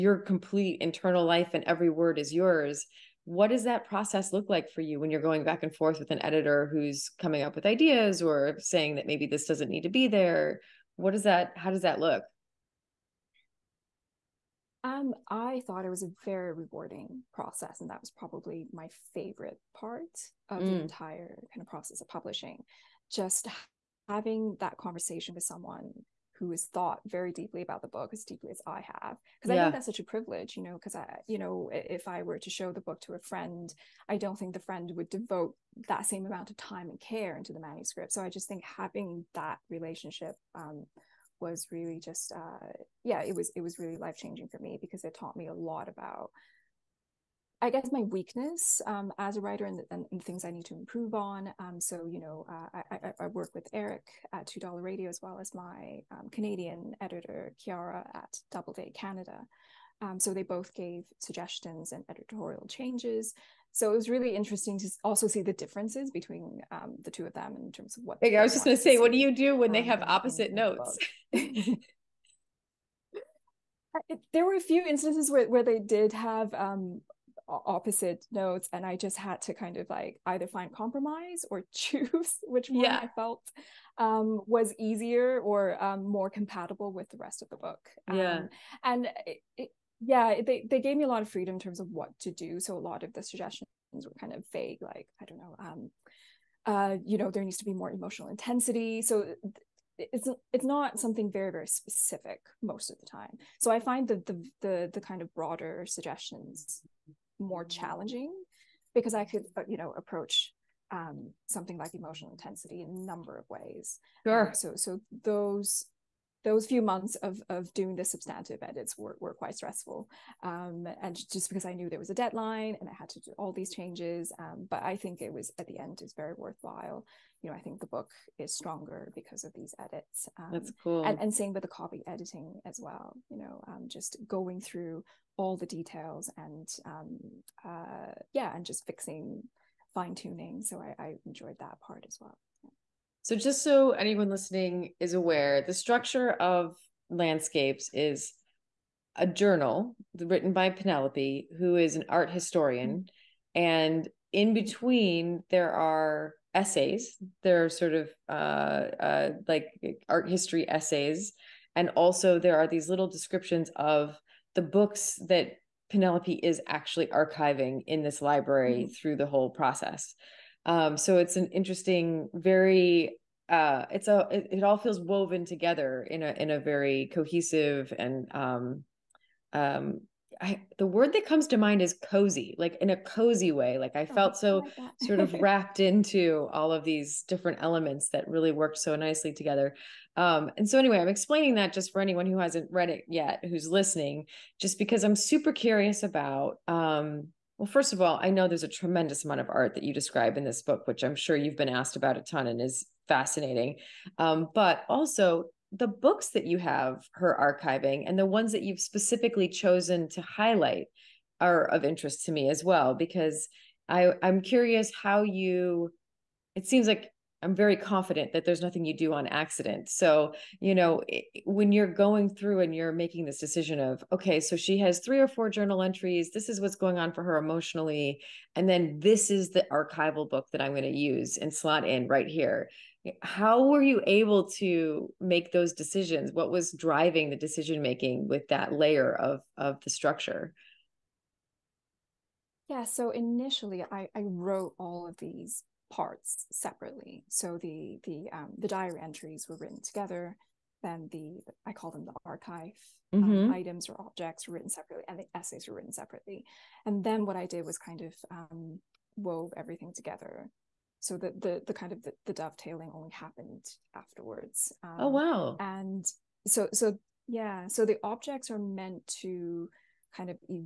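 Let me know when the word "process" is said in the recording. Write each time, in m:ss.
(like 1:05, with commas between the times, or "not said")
0:03, 0:17, 0:21, 2:49.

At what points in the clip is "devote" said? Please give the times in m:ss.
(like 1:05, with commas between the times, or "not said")
0:35.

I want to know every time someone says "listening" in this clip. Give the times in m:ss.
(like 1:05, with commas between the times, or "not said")
2:24, 3:13.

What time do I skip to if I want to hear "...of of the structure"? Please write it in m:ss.
3:59.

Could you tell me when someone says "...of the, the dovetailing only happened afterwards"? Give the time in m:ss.
4:21.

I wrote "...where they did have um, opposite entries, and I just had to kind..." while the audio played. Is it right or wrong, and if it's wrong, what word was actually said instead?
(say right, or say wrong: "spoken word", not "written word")
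wrong: "notes", not "entries".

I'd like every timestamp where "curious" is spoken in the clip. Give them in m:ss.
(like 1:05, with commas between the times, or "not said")
3:15, 3:34.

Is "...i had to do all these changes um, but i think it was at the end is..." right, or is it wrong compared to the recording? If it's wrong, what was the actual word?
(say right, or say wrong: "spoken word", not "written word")
right.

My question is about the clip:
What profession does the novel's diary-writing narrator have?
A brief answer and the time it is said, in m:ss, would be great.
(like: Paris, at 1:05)
Art historian, at 2:32.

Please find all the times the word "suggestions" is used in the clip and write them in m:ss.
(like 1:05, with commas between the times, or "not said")
1:01, 1:33, 1:45.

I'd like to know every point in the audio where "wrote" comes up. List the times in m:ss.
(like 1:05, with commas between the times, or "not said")
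4:04.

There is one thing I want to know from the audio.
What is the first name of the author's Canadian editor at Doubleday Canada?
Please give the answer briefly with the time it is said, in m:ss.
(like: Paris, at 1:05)
Kiara, at 0:57.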